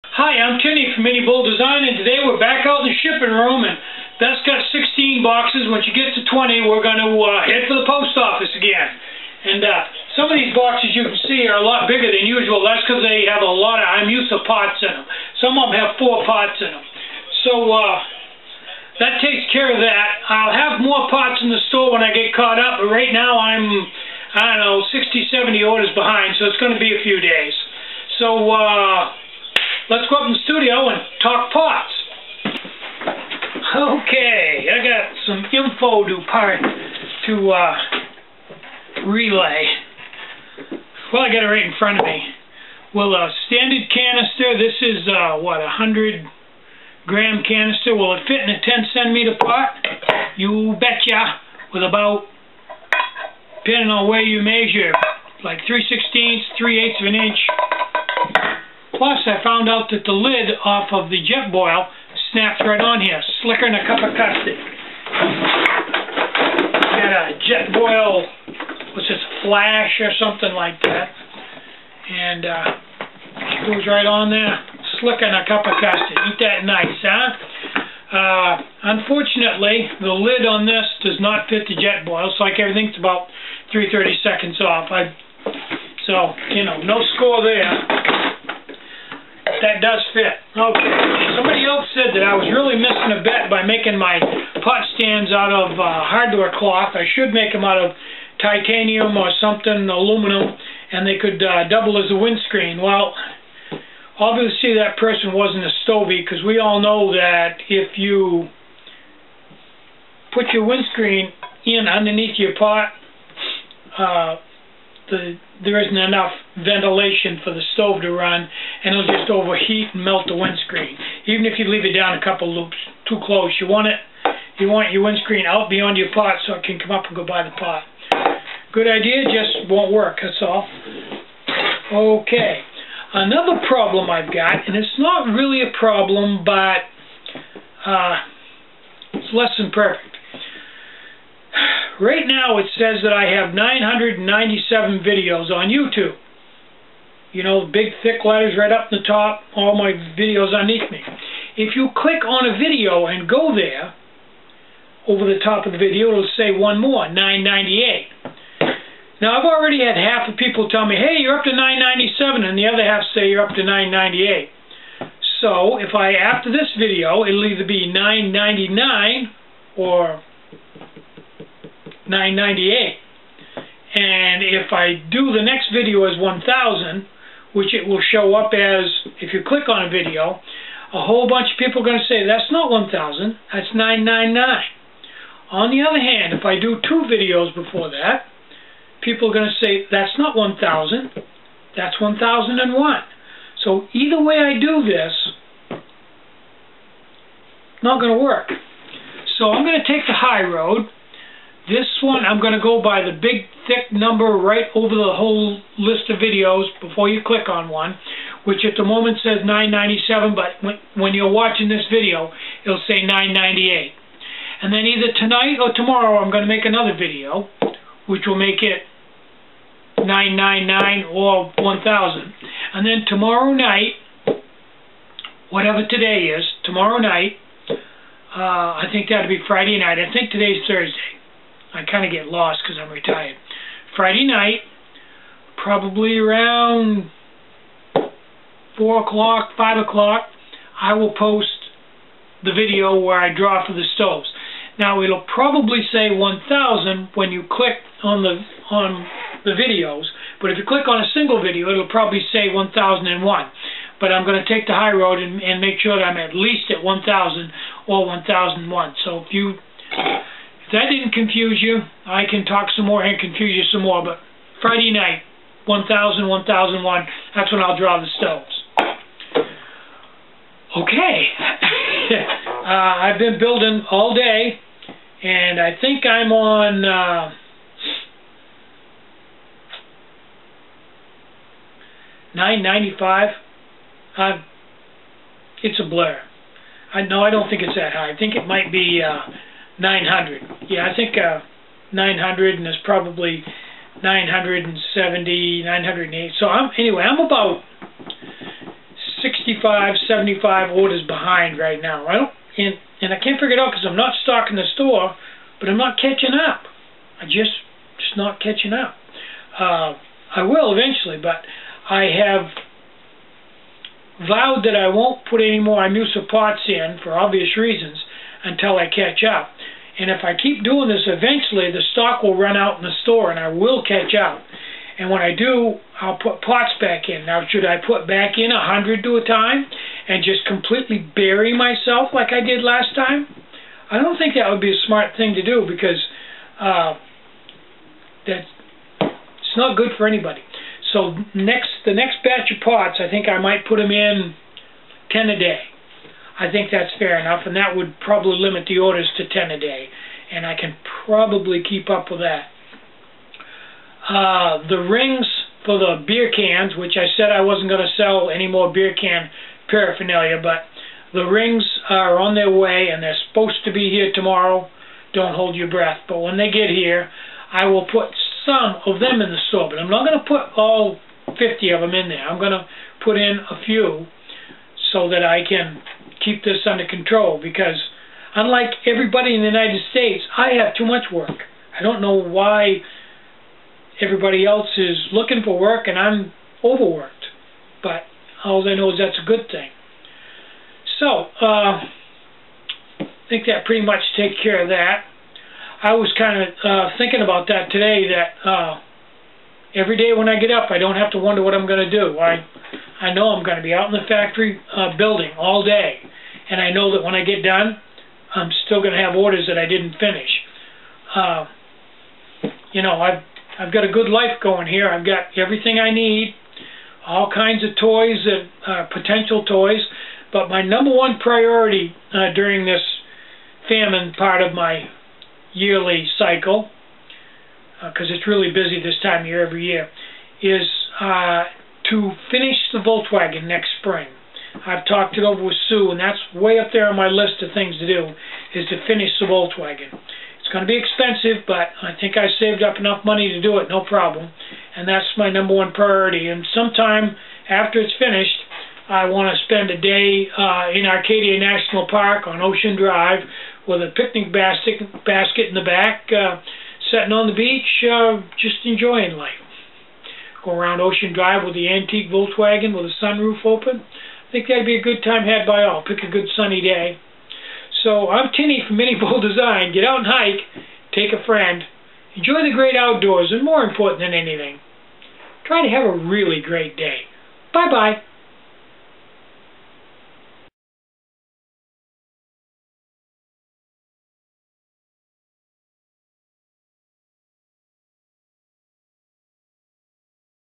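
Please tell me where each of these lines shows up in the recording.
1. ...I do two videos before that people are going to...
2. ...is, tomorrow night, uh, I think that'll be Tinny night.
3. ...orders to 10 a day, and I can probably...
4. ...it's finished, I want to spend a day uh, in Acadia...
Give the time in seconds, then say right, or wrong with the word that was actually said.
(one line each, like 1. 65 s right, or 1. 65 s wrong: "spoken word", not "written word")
1. 186 s right
2. 226 s wrong: "Friday", not "Tinny"
3. 348 s right
4. 447 s right.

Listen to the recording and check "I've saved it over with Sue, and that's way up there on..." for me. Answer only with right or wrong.
wrong.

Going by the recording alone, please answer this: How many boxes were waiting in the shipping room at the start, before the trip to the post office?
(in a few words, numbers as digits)
16.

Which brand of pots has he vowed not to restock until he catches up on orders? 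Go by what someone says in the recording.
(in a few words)
Imusa.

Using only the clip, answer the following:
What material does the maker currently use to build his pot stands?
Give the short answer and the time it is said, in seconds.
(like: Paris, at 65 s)
hardware cloth, at 96 s.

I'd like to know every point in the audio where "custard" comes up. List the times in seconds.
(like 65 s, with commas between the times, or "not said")
64 s, 75 s.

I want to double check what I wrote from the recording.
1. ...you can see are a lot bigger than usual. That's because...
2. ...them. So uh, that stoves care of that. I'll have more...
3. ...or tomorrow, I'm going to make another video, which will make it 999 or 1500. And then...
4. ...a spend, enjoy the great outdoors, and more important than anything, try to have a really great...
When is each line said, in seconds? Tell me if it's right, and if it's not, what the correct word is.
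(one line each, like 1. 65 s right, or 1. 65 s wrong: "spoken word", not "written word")
1. 10 s right
2. 16 s wrong: "takes", not "stoves"
3. 215 s wrong: "1000", not "1500"
4. 471 s wrong: "friend", not "spend".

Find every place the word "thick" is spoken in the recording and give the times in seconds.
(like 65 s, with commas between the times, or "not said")
148 s, 203 s.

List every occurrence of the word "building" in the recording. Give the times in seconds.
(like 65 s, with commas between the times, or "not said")
273 s, 404 s.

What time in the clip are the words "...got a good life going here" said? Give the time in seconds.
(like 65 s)
413 s.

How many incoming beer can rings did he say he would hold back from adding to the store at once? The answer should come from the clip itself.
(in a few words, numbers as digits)
50.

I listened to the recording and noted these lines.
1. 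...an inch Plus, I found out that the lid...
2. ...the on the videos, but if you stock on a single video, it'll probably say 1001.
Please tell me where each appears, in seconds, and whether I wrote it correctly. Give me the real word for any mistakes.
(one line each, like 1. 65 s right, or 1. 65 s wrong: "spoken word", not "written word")
1. 57 s right
2. 248 s wrong: "click", not "stock".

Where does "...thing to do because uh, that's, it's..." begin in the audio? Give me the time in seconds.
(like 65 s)
335 s.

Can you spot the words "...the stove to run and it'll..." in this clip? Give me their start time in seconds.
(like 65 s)
117 s.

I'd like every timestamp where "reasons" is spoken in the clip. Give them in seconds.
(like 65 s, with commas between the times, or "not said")
317 s.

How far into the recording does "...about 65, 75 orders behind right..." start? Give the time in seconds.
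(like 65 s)
297 s.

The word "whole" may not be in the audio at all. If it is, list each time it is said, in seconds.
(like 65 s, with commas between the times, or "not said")
181 s, 205 s.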